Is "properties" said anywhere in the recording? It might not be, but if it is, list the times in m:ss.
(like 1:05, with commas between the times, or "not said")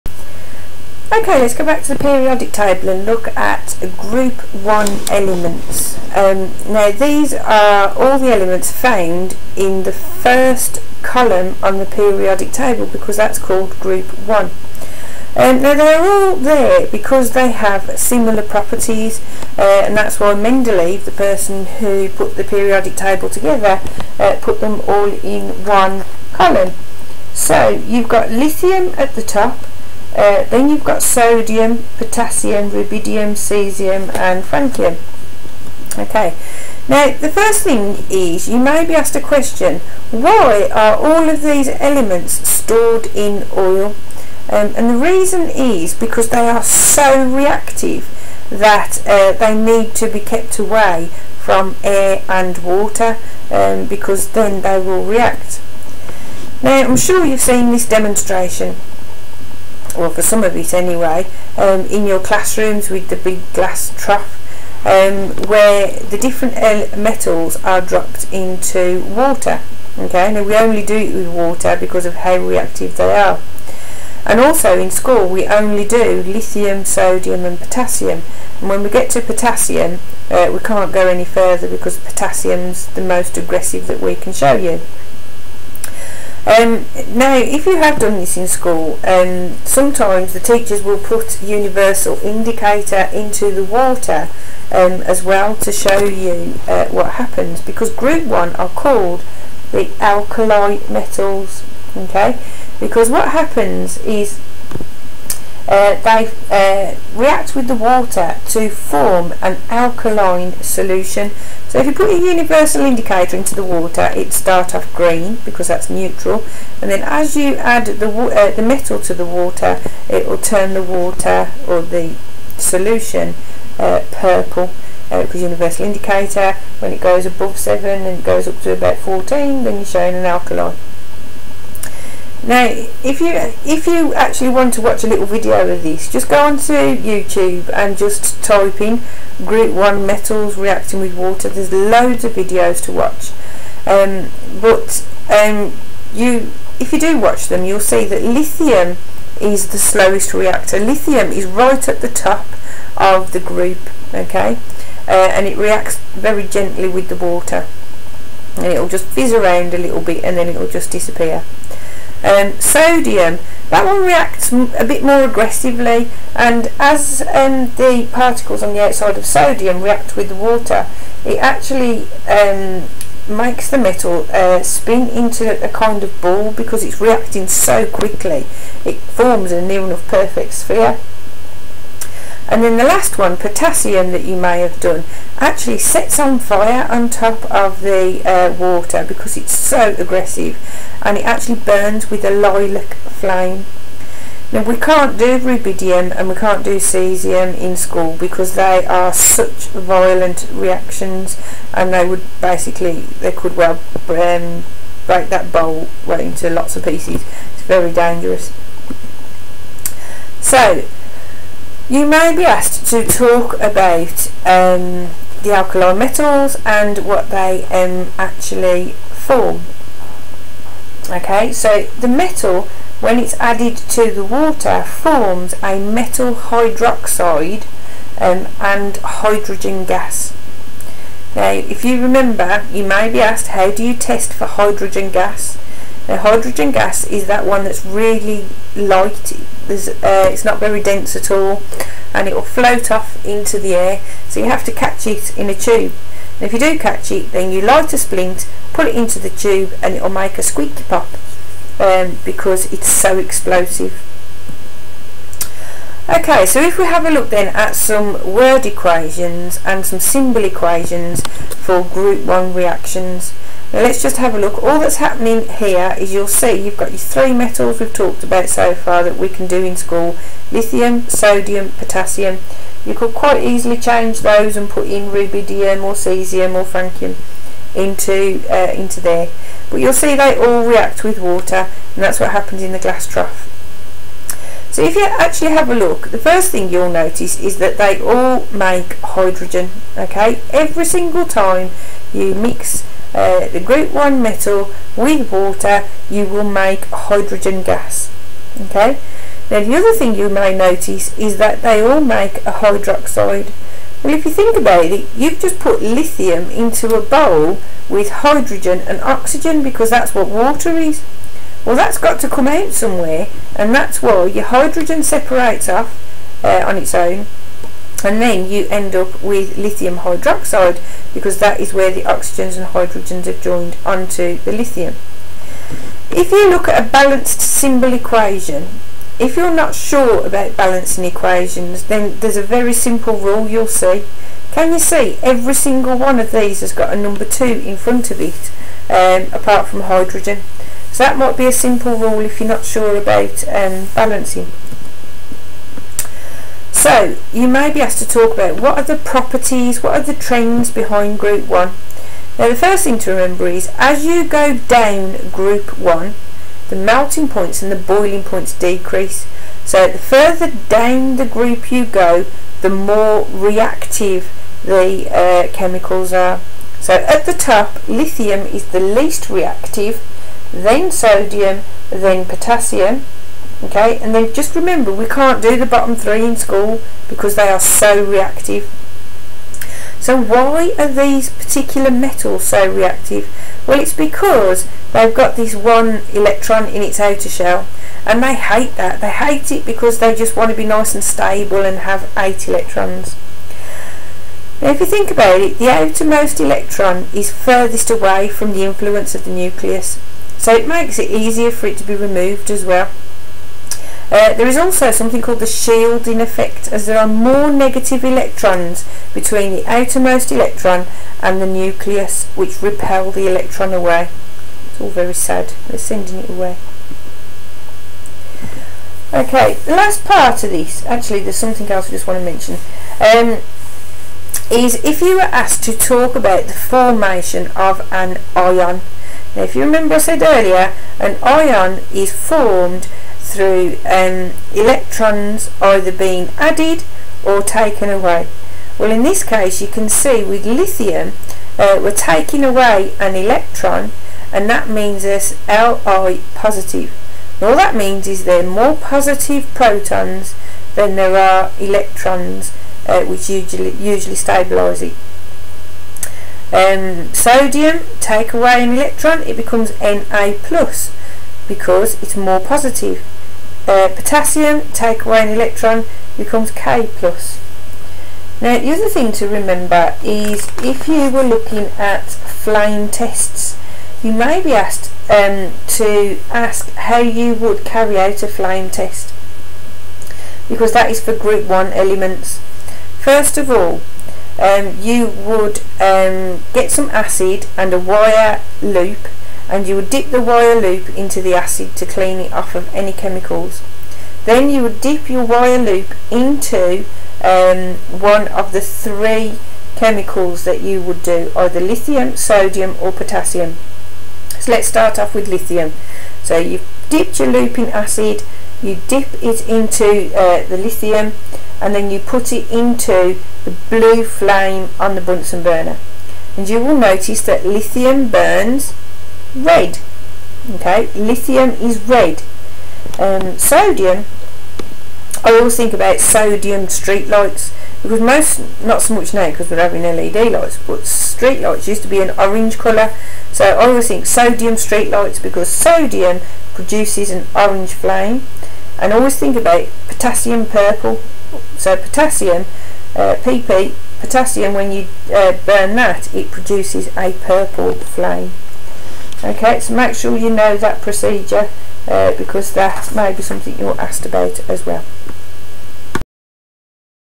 0:18, 5:48.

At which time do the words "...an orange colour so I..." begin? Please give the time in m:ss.
8:52.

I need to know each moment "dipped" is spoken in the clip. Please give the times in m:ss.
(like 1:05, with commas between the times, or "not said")
8:26.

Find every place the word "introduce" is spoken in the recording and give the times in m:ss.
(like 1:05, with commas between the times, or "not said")
not said.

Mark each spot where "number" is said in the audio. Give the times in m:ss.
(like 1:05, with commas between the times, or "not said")
5:36.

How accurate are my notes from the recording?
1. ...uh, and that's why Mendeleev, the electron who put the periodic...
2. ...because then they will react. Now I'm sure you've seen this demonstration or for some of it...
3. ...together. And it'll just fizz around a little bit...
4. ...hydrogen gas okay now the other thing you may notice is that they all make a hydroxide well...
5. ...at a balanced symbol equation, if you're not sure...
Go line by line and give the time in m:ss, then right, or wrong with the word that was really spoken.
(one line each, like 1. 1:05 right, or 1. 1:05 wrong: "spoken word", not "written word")
1. 0:19 wrong: "person", not "electron"
2. 0:53 right
3. 2:37 wrong: "water", not "together"
4. 4:56 right
5. 5:26 right.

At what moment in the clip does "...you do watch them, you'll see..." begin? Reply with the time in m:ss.
2:26.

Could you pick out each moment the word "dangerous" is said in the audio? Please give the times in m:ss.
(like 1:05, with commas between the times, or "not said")
3:27.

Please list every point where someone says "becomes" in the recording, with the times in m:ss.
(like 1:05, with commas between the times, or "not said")
7:39, 7:46.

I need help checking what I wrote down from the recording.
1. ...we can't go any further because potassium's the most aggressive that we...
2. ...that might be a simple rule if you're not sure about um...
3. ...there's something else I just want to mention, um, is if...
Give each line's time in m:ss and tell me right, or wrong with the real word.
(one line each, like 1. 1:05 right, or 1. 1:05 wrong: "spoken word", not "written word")
1. 1:20 right
2. 5:41 right
3. 7:01 right.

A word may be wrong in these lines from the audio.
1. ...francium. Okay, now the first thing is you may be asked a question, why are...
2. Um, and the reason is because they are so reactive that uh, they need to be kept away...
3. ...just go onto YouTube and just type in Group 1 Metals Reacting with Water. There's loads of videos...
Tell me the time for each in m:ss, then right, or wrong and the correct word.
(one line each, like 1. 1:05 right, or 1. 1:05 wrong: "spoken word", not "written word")
1. 0:34 right
2. 0:44 right
3. 2:16 right.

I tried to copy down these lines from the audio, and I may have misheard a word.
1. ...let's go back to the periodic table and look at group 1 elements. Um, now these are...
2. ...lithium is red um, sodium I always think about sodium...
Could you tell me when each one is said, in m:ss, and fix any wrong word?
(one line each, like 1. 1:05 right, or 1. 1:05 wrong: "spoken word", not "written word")
1. 0:01 right
2. 8:40 right.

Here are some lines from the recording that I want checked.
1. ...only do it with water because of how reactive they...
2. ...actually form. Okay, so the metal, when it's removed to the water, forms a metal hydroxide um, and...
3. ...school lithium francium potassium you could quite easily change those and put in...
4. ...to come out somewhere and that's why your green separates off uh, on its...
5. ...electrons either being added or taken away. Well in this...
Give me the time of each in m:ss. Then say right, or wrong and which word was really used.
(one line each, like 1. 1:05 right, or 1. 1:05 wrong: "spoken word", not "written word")
1. 1:10 right
2. 3:38 wrong: "added", not "removed"
3. 4:29 wrong: "sodium", not "francium"
4. 5:12 wrong: "hydrogen", not "green"
5. 7:14 right.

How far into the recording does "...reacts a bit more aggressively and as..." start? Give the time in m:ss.
2:44.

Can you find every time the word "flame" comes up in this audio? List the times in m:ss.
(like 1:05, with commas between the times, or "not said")
3:12, 7:52, 7:58, 8:34, 8:57, 9:07.